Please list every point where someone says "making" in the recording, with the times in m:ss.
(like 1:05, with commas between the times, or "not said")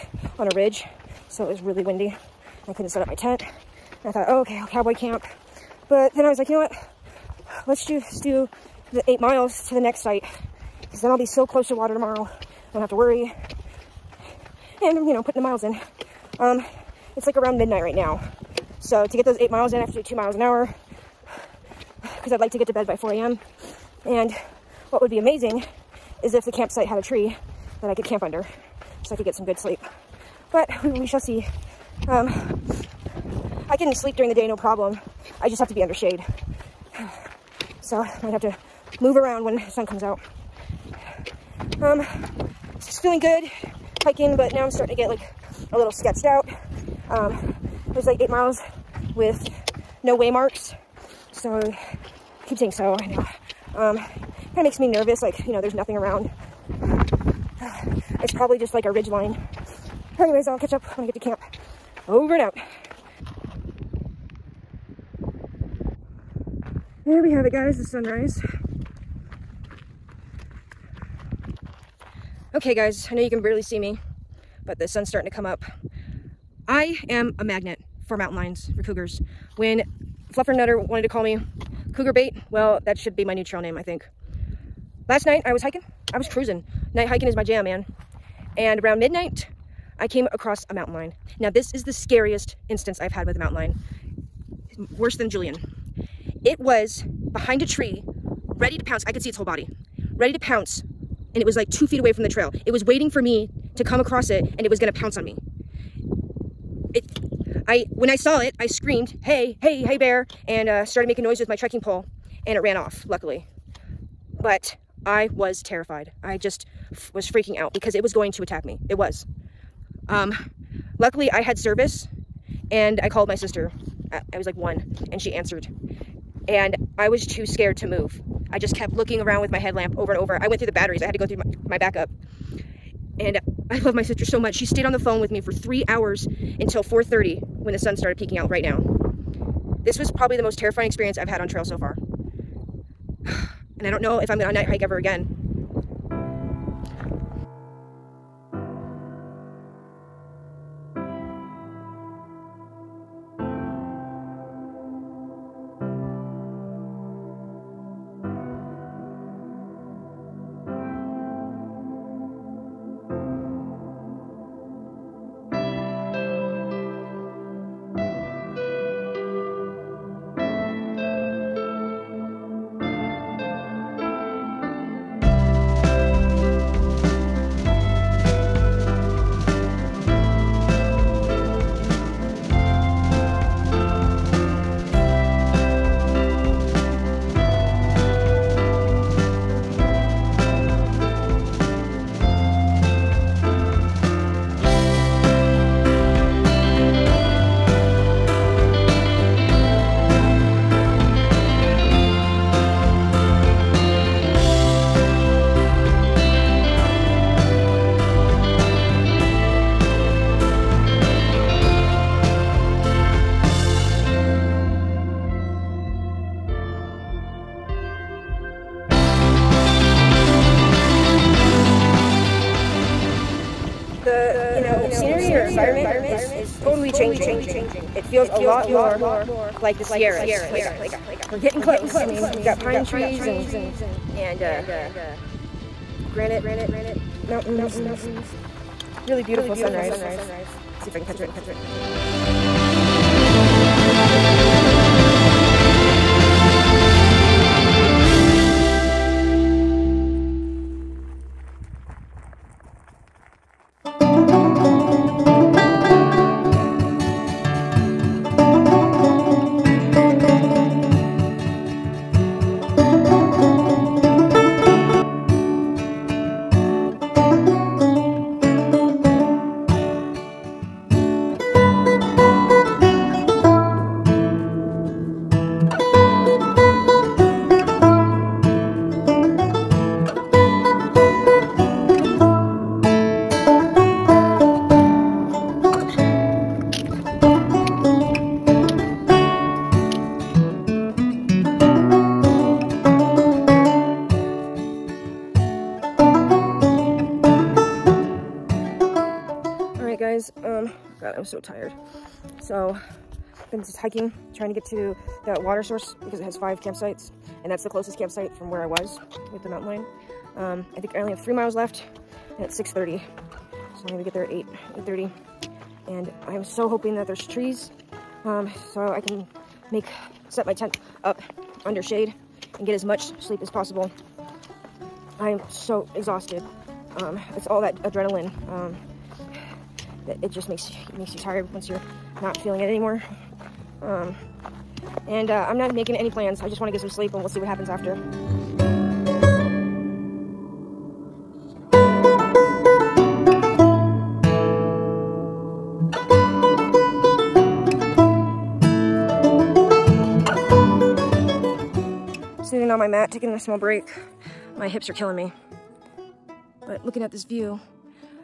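1:51, 5:35.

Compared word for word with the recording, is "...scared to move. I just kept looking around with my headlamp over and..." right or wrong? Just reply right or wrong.
right.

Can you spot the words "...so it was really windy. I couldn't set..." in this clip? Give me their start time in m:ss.
0:01.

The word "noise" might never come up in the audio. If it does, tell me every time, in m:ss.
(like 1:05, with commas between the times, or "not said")
1:51.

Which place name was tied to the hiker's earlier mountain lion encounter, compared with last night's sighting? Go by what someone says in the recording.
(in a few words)
Julian.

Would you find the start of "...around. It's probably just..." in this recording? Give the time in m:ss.
0:55.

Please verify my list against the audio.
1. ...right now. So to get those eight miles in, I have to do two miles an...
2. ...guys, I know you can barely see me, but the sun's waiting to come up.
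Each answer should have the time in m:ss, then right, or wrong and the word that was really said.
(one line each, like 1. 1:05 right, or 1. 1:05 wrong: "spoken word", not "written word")
1. 0:17 right
2. 1:12 wrong: "starting", not "waiting".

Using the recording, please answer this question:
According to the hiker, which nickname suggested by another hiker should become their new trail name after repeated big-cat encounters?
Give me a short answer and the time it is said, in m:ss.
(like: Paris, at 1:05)
Cougar Bait, at 1:21.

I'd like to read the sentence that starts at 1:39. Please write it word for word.
I could see its whole body, ready to pounce.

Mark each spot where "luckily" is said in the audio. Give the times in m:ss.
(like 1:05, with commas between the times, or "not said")
1:53, 2:00.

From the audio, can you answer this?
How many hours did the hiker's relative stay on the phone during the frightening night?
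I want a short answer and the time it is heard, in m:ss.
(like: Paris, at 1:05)
3, at 2:15.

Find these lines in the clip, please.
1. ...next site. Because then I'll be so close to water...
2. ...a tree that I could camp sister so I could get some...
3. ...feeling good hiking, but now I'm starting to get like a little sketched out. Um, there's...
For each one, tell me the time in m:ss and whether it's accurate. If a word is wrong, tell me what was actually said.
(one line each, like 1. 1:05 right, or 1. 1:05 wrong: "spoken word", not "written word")
1. 0:09 right
2. 0:26 wrong: "under", not "sister"
3. 0:43 right.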